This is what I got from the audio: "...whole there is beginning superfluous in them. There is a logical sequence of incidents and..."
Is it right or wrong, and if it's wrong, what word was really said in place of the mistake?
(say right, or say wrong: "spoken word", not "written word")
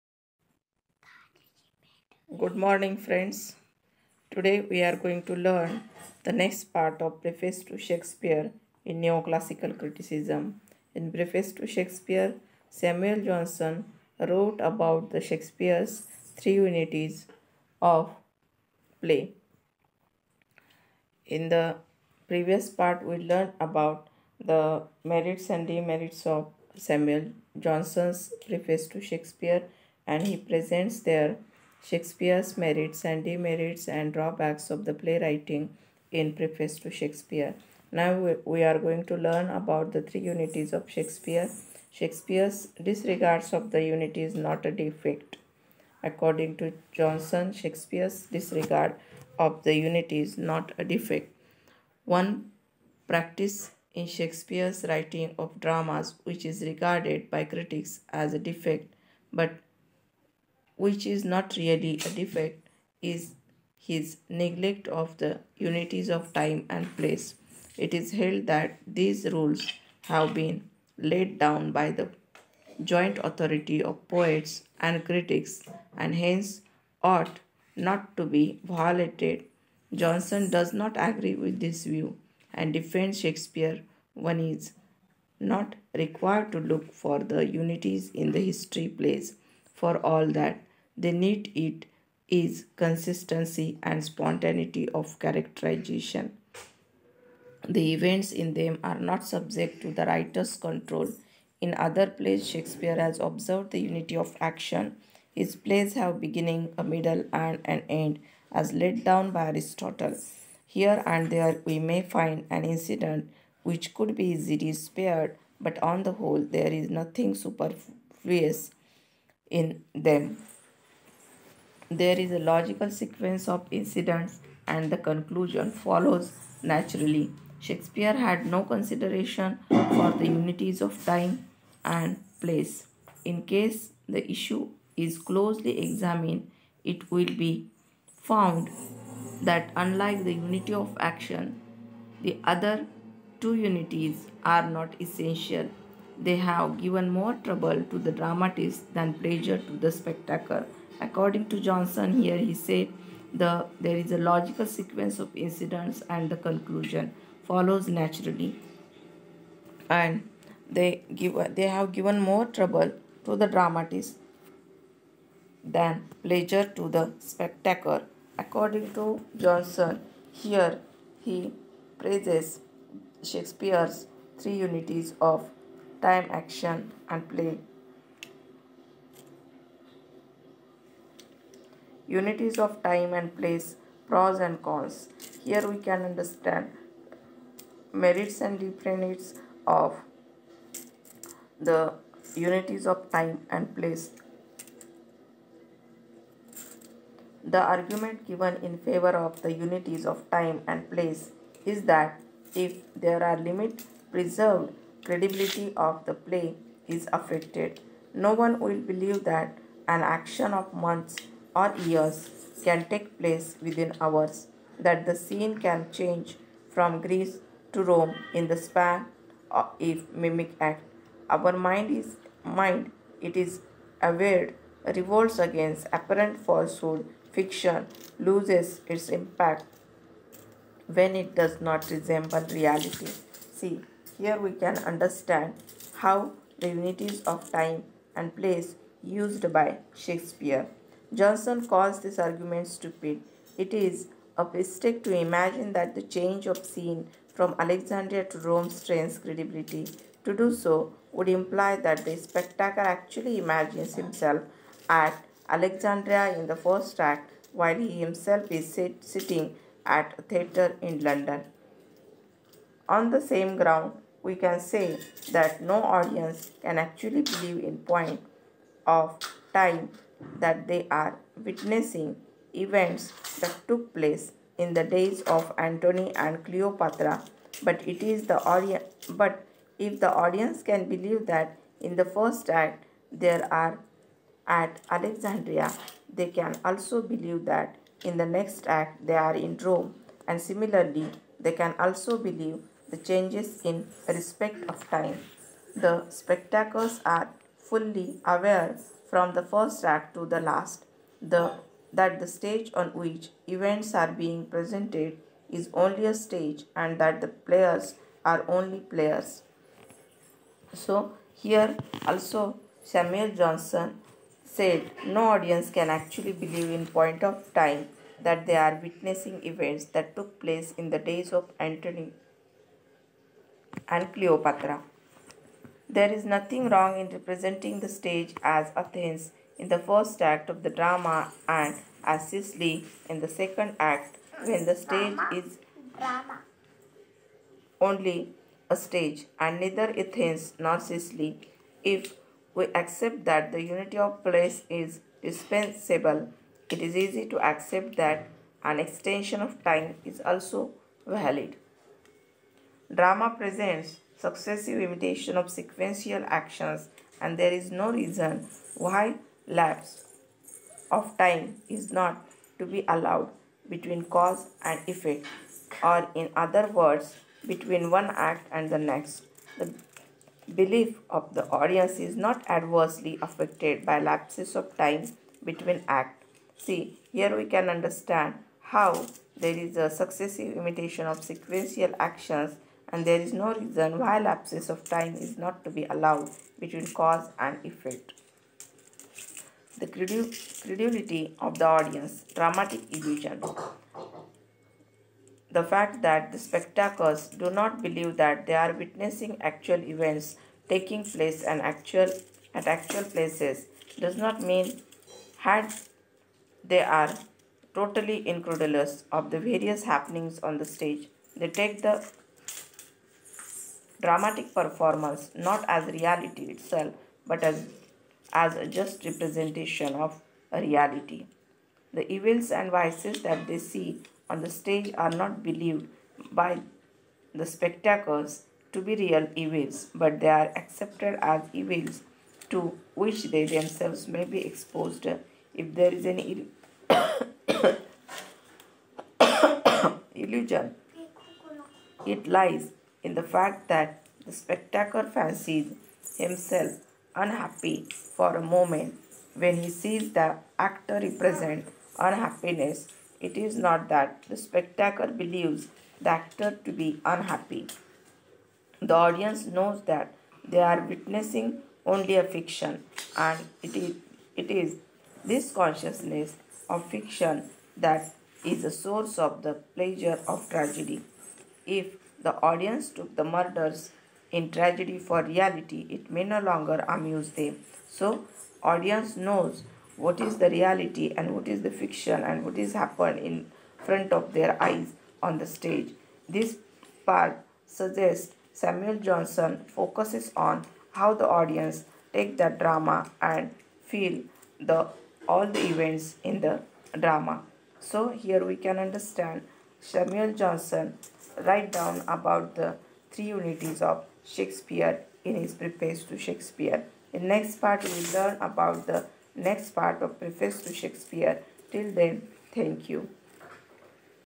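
wrong: "nothing", not "beginning".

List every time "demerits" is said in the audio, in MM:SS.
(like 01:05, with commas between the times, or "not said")
00:25, 00:33, 03:08.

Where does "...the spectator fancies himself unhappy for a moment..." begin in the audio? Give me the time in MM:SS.
07:24.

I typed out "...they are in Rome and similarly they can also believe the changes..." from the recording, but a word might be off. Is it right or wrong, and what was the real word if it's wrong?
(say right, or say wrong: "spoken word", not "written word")
right.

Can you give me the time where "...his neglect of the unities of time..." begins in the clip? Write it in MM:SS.
01:03.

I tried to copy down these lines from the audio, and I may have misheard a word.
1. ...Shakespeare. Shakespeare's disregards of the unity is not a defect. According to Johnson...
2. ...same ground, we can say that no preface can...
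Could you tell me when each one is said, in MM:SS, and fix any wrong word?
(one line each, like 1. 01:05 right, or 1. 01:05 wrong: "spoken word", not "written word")
1. 00:40 right
2. 04:23 wrong: "audience", not "preface".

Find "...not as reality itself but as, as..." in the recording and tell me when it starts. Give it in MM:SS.
06:55.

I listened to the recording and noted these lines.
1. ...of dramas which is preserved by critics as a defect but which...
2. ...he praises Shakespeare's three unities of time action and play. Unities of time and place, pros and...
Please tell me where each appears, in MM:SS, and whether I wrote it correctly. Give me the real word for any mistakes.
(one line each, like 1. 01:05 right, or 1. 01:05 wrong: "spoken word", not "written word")
1. 00:55 wrong: "regarded", not "preserved"
2. 02:51 right.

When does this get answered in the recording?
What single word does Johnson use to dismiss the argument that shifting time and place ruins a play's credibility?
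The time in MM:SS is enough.
04:02.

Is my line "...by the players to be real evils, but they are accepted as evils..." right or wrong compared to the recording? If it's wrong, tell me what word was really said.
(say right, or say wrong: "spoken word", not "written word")
wrong: "spectators", not "players".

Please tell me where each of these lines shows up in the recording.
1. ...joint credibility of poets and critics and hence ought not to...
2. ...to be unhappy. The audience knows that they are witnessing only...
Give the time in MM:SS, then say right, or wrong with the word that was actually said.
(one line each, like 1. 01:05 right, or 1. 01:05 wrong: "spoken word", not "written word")
1. 01:12 wrong: "authority", not "credibility"
2. 07:36 right.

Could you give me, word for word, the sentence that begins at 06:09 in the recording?
The belief of the audience is not adversely affected by lapses of time between acts.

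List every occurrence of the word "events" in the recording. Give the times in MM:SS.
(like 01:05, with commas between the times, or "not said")
01:37, 04:32, 05:03, 05:19, 06:39, 08:15.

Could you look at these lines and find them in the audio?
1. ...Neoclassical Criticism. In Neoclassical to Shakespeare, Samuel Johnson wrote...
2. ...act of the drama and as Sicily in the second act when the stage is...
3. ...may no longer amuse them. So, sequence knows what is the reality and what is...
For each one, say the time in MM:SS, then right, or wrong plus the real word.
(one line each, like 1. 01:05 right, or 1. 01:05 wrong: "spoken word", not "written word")
1. 00:09 wrong: "Preface", not "Neoclassical"
2. 05:30 right
3. 07:56 wrong: "audience", not "sequence".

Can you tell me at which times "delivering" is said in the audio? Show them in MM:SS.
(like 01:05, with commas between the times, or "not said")
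not said.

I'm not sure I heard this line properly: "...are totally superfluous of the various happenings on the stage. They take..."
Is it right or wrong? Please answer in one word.
wrong.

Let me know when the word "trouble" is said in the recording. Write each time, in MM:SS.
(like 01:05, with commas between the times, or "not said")
02:27, 02:42.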